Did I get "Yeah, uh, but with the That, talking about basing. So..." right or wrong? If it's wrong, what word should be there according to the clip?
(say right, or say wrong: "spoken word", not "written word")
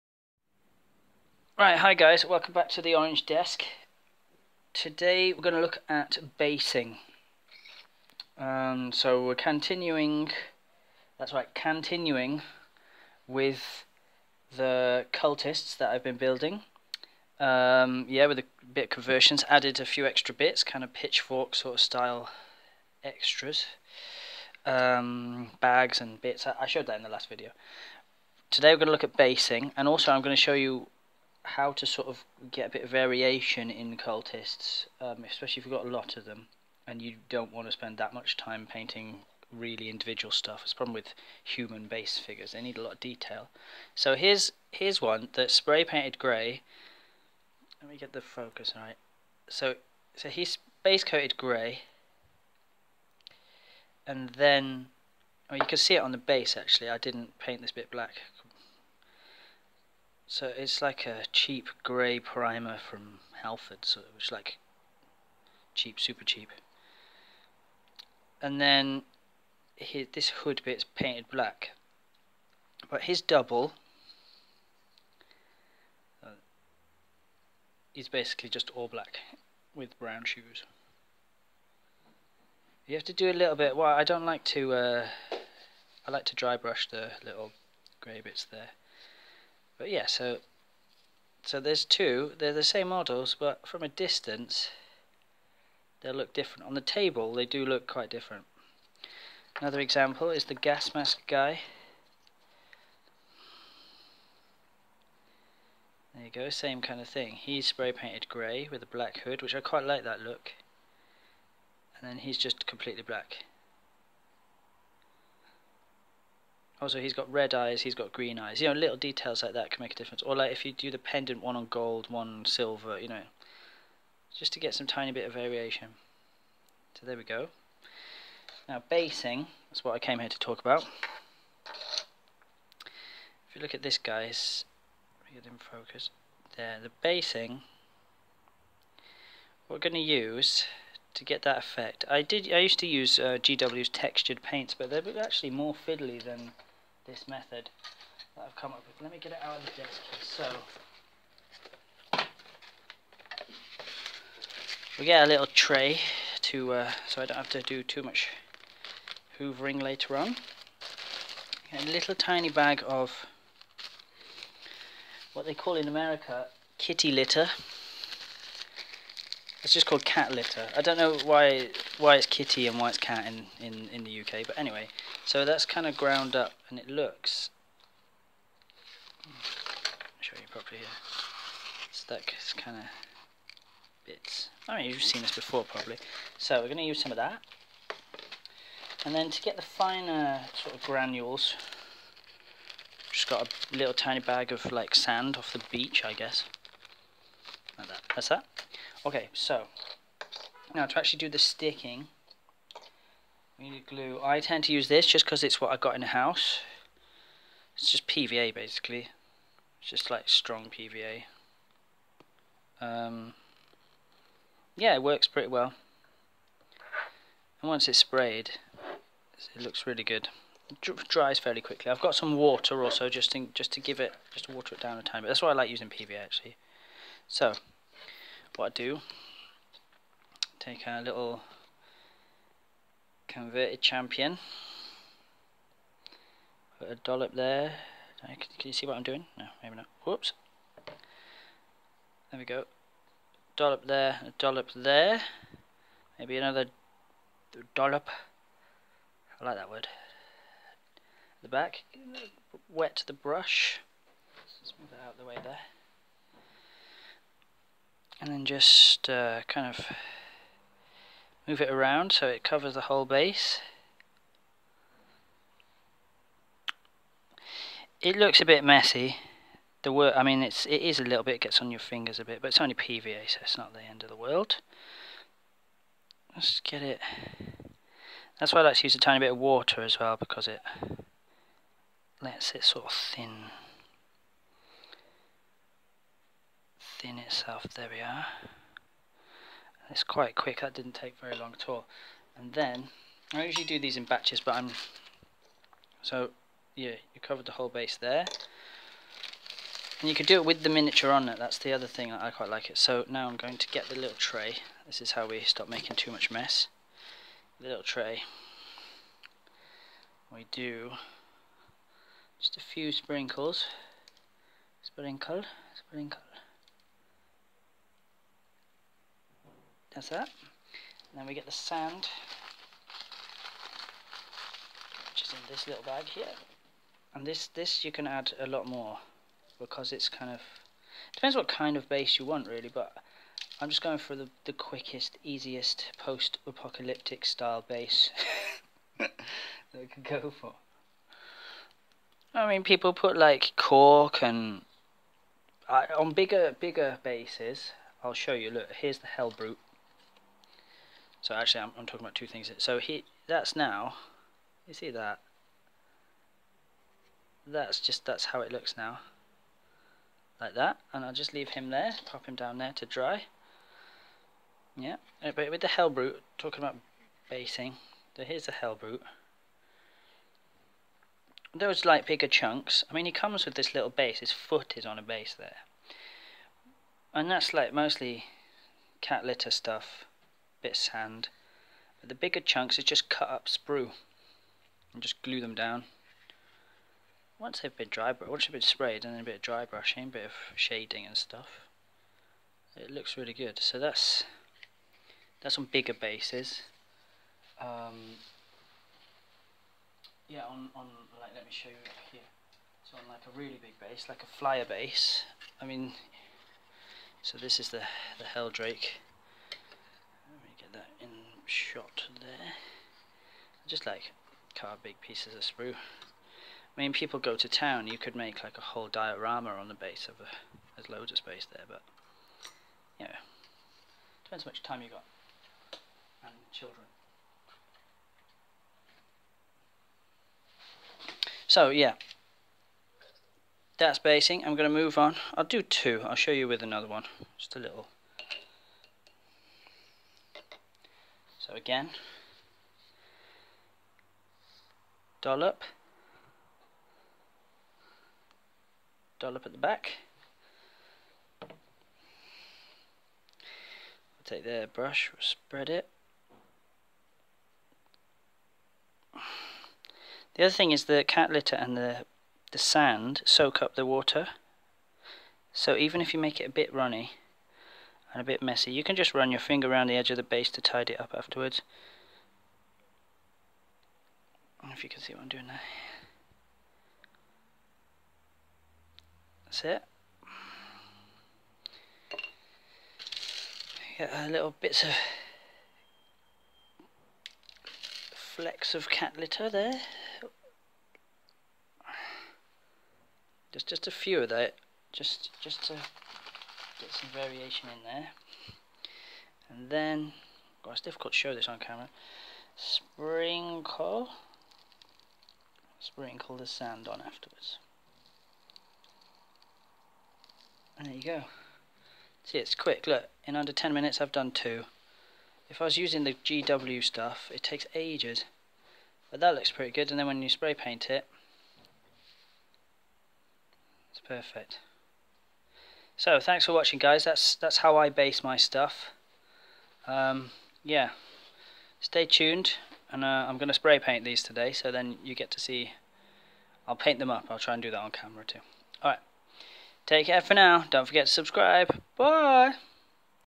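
wrong: "Helbrute", not "That".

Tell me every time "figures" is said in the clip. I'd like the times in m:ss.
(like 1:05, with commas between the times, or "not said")
0:42.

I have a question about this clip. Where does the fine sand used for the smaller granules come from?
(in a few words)
The beach.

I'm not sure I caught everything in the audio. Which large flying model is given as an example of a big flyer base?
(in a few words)
Heldrake.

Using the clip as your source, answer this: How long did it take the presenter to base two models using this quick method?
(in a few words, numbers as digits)
Under 10 minutes.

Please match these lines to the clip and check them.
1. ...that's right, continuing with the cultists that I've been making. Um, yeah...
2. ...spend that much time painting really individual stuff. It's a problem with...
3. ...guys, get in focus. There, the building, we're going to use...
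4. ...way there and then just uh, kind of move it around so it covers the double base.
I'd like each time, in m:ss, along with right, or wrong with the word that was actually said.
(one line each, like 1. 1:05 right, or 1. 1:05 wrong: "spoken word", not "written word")
1. 0:11 wrong: "building", not "making"
2. 0:37 right
3. 2:13 wrong: "basing", not "building"
4. 4:15 wrong: "whole", not "double".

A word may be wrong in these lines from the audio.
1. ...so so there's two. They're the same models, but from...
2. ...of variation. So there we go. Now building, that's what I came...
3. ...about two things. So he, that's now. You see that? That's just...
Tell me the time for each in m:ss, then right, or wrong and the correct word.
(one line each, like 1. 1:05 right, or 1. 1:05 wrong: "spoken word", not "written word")
1. 1:30 right
2. 2:05 wrong: "basing", not "building"
3. 5:52 right.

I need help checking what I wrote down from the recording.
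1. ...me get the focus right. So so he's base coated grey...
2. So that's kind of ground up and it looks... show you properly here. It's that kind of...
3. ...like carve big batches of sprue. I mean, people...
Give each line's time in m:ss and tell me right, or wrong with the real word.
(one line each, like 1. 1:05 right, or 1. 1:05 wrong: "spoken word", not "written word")
1. 0:47 right
2. 2:55 right
3. 6:53 wrong: "pieces", not "batches".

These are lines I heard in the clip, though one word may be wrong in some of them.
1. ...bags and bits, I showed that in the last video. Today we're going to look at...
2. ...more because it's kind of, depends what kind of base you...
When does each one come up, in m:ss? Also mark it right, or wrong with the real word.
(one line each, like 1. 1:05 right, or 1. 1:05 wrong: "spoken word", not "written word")
1. 0:25 right
2. 5:28 right.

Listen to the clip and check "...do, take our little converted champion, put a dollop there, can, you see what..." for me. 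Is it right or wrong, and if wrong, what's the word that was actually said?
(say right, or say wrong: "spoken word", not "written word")
right.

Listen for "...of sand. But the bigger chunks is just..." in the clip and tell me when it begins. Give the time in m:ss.
6:20.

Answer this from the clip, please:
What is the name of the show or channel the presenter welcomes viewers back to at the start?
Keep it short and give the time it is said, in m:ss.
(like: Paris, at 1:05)
The Orange Desk, at 0:02.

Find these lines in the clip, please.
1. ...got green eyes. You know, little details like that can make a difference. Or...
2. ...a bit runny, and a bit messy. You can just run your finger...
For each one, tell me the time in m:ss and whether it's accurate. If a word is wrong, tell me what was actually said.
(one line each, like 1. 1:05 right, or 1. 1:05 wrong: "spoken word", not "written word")
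1. 1:57 right
2. 7:46 right.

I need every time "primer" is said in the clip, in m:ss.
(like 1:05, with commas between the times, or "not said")
1:02.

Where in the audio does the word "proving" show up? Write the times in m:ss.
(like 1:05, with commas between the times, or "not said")
not said.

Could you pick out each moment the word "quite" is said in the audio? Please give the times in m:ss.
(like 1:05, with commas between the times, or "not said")
1:37, 1:49, 4:50, 5:02.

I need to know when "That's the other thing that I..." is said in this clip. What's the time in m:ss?
5:01.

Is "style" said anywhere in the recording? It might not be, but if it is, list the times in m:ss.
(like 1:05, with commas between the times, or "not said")
0:21, 5:37.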